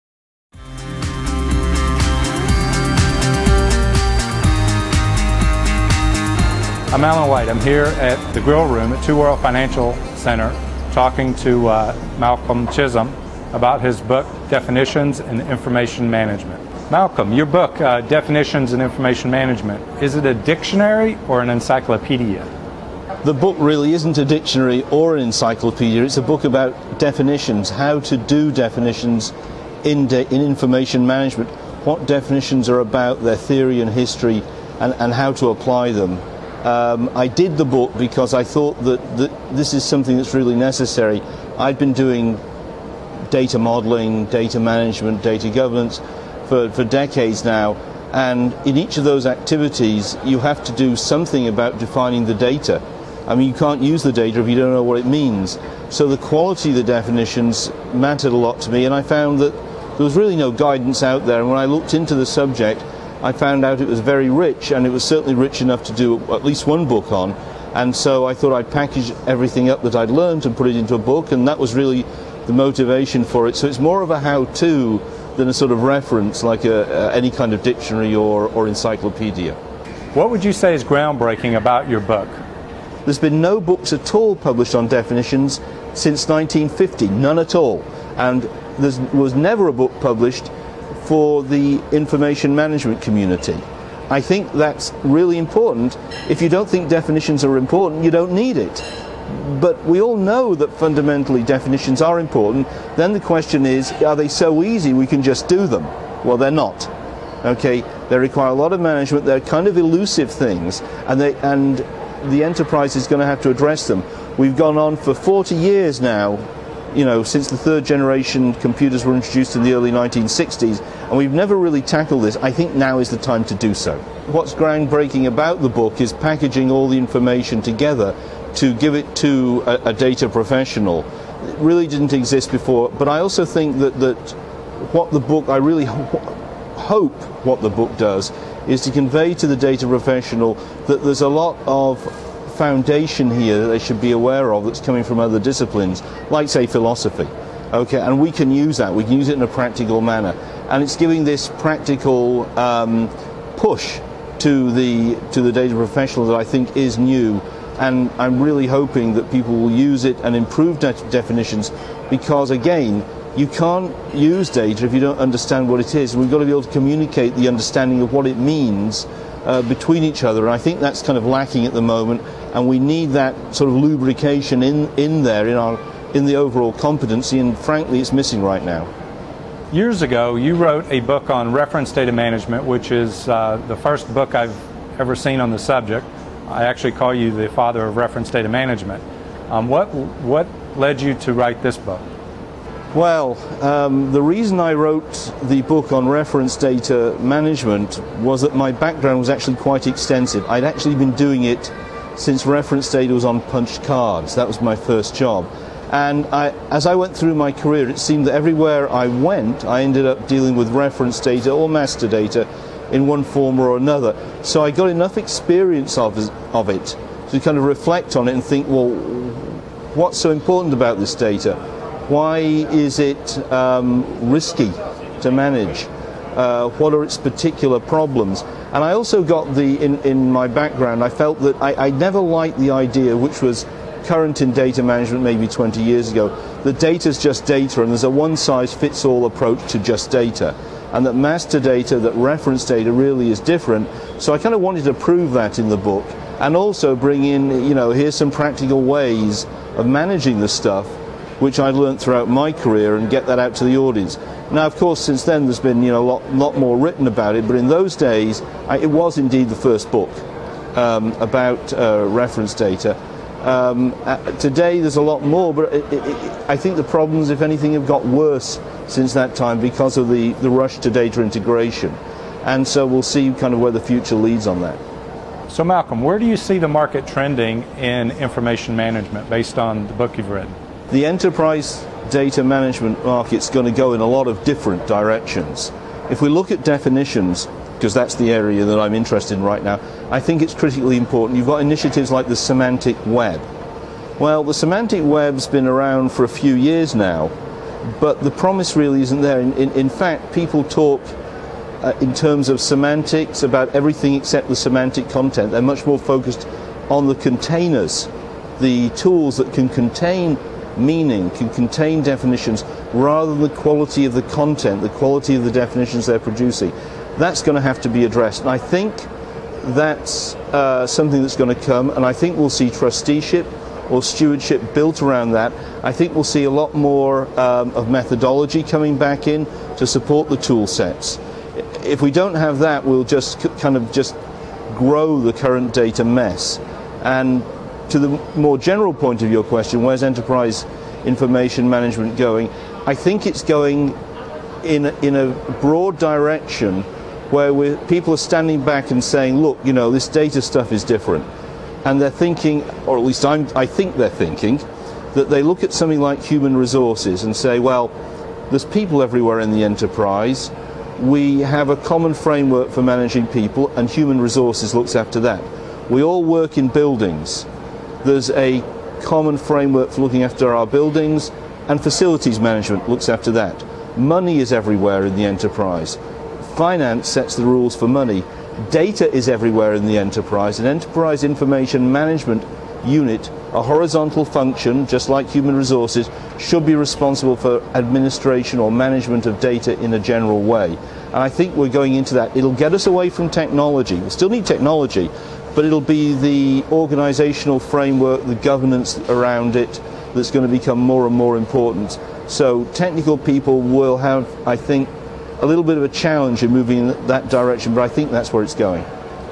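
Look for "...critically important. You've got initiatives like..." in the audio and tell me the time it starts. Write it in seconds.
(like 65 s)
290 s.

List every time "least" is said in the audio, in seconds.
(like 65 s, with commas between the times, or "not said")
66 s, 353 s.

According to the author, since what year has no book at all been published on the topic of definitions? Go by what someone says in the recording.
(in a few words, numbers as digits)
1950.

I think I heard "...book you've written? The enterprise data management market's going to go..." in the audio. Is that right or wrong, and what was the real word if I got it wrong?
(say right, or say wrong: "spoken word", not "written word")
right.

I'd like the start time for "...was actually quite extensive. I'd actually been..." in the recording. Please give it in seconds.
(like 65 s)
199 s.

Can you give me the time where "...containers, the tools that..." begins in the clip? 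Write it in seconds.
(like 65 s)
307 s.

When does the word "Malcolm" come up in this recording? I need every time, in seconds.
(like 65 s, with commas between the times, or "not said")
12 s, 16 s, 275 s.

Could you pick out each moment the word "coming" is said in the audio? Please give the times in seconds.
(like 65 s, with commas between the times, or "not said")
144 s, 328 s.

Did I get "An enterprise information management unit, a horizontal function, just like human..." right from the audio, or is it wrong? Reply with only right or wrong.
right.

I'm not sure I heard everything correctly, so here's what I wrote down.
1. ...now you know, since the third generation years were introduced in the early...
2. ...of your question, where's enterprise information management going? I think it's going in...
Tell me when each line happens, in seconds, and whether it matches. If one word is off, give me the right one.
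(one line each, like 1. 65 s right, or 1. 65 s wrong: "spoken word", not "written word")
1. 116 s wrong: "computers", not "years"
2. 339 s right.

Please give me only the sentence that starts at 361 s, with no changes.
We have a common framework for managing people, and human resources looks after that.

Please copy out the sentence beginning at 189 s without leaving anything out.
Um, what, what led you to write this book?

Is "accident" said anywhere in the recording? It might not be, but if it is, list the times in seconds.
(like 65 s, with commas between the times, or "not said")
not said.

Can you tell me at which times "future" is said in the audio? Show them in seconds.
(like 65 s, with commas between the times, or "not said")
273 s.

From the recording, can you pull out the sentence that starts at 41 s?
I'd been doing data modeling, data management, data governance for, for decades now.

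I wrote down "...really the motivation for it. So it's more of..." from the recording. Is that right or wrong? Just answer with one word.
right.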